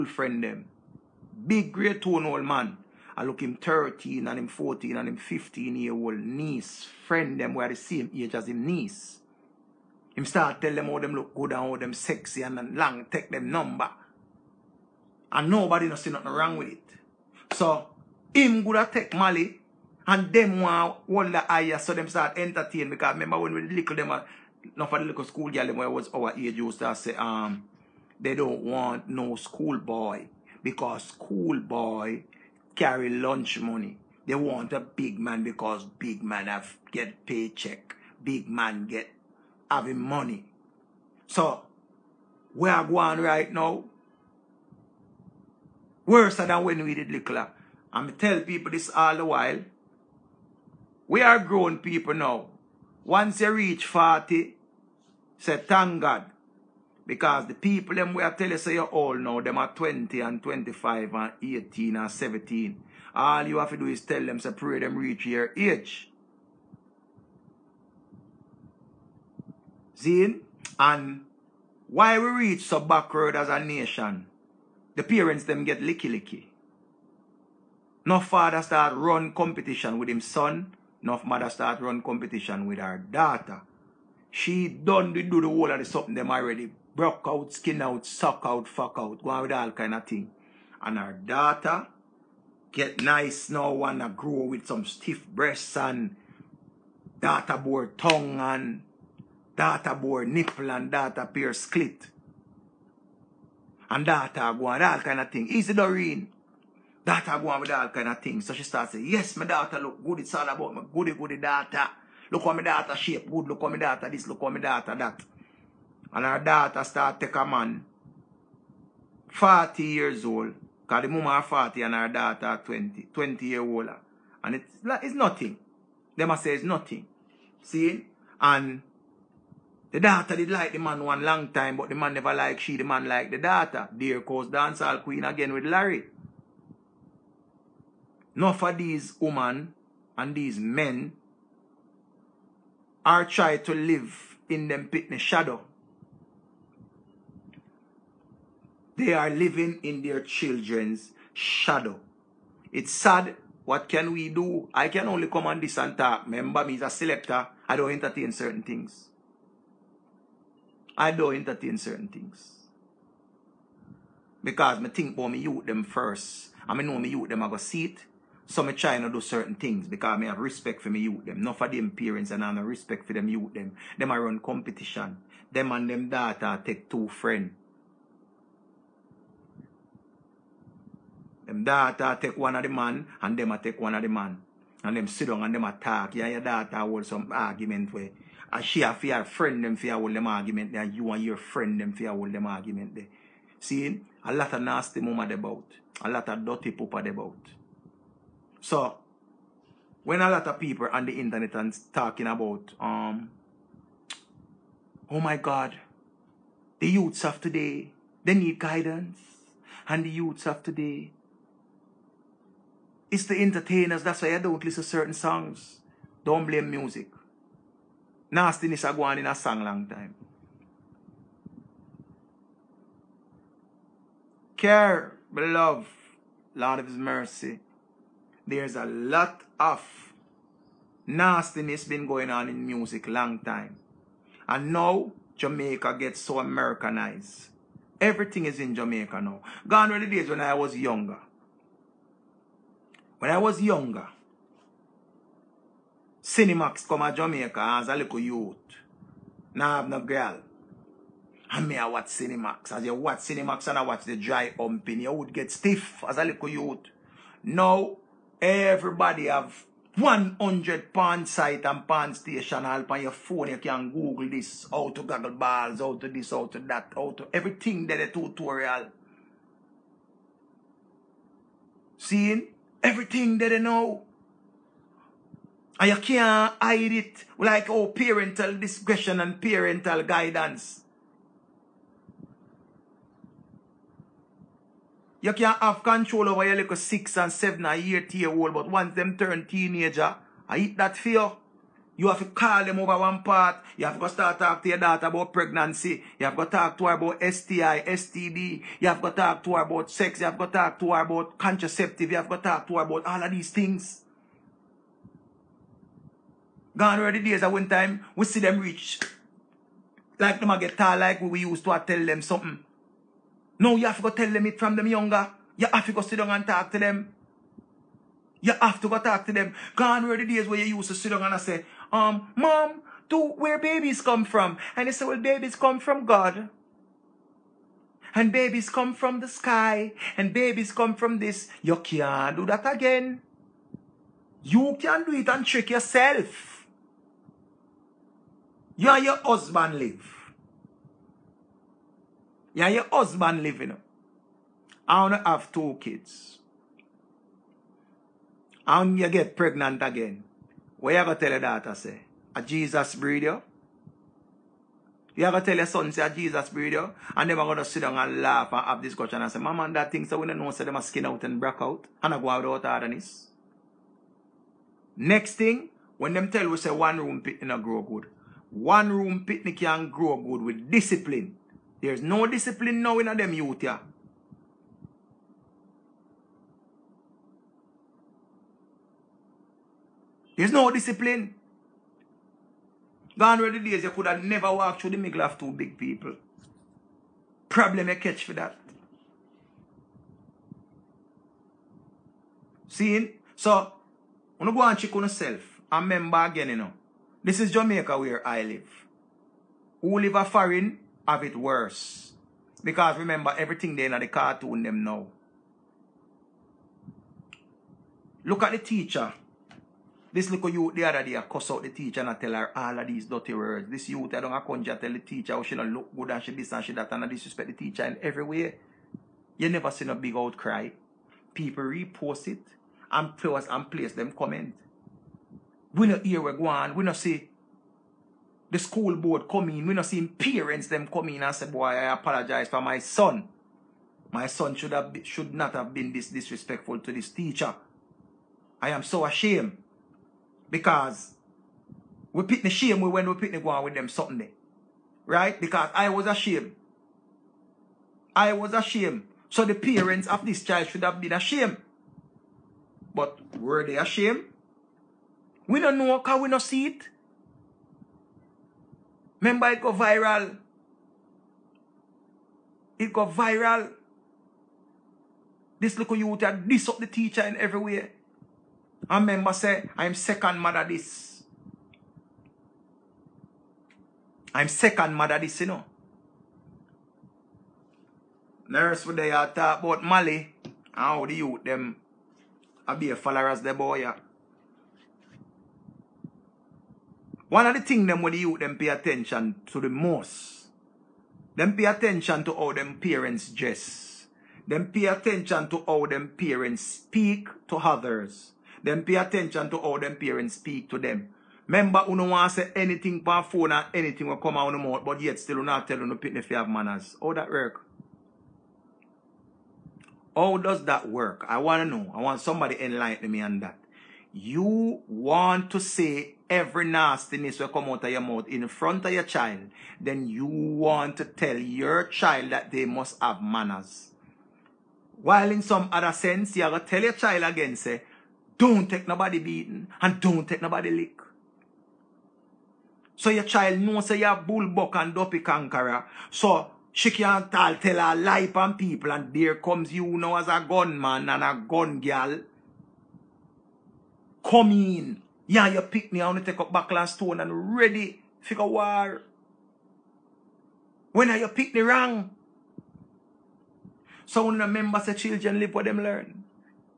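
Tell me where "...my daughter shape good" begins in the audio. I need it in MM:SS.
01:52.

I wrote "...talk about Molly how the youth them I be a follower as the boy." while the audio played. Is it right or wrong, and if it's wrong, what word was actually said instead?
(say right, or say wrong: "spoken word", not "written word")
right.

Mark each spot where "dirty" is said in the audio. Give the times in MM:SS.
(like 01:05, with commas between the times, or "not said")
03:16, 06:53.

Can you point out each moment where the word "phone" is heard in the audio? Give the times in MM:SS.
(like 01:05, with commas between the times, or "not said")
04:23, 08:23.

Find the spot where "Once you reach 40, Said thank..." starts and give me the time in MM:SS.
00:53.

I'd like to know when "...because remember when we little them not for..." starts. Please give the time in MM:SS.
00:22.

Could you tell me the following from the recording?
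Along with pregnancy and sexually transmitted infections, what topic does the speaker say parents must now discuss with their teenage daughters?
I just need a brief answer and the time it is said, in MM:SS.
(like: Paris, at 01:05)
contraceptive, at 05:01.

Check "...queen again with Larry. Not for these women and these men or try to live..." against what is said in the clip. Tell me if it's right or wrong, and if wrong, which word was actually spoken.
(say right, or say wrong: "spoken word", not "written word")
right.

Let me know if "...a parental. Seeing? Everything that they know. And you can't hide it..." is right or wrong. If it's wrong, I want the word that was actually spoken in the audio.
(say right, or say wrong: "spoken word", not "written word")
wrong: "tutorial", not "parental".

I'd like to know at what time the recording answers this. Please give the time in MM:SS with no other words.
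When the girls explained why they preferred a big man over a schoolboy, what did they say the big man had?
00:37.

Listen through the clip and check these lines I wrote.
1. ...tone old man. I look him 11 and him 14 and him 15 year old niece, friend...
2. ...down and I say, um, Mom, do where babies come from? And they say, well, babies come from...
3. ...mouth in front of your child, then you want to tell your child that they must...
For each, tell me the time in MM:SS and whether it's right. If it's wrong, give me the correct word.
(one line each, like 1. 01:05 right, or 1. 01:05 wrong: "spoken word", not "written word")
1. 00:02 wrong: "13", not "11"
2. 05:21 right
3. 08:37 right.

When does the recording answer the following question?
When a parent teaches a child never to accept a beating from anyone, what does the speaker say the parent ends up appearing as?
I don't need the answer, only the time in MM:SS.
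09:00.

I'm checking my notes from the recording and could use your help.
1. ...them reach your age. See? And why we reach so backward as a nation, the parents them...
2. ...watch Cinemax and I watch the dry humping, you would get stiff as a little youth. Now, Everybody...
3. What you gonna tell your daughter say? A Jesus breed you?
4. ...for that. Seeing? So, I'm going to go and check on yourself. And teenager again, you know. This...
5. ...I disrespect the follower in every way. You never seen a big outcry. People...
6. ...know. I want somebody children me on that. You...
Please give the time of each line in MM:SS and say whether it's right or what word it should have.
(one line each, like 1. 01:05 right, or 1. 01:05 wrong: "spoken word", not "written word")
1. 01:04 right
2. 04:12 right
3. 05:50 right
4. 06:28 wrong: "remember", not "teenager"
5. 06:57 wrong: "teacher", not "follower"
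6. 08:31 wrong: "enlighten", not "children".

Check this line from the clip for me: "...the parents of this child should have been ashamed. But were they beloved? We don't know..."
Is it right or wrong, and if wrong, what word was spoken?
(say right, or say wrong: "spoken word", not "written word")
wrong: "ashamed", not "beloved".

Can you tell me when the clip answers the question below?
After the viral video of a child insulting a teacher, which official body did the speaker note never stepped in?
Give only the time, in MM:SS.
07:08.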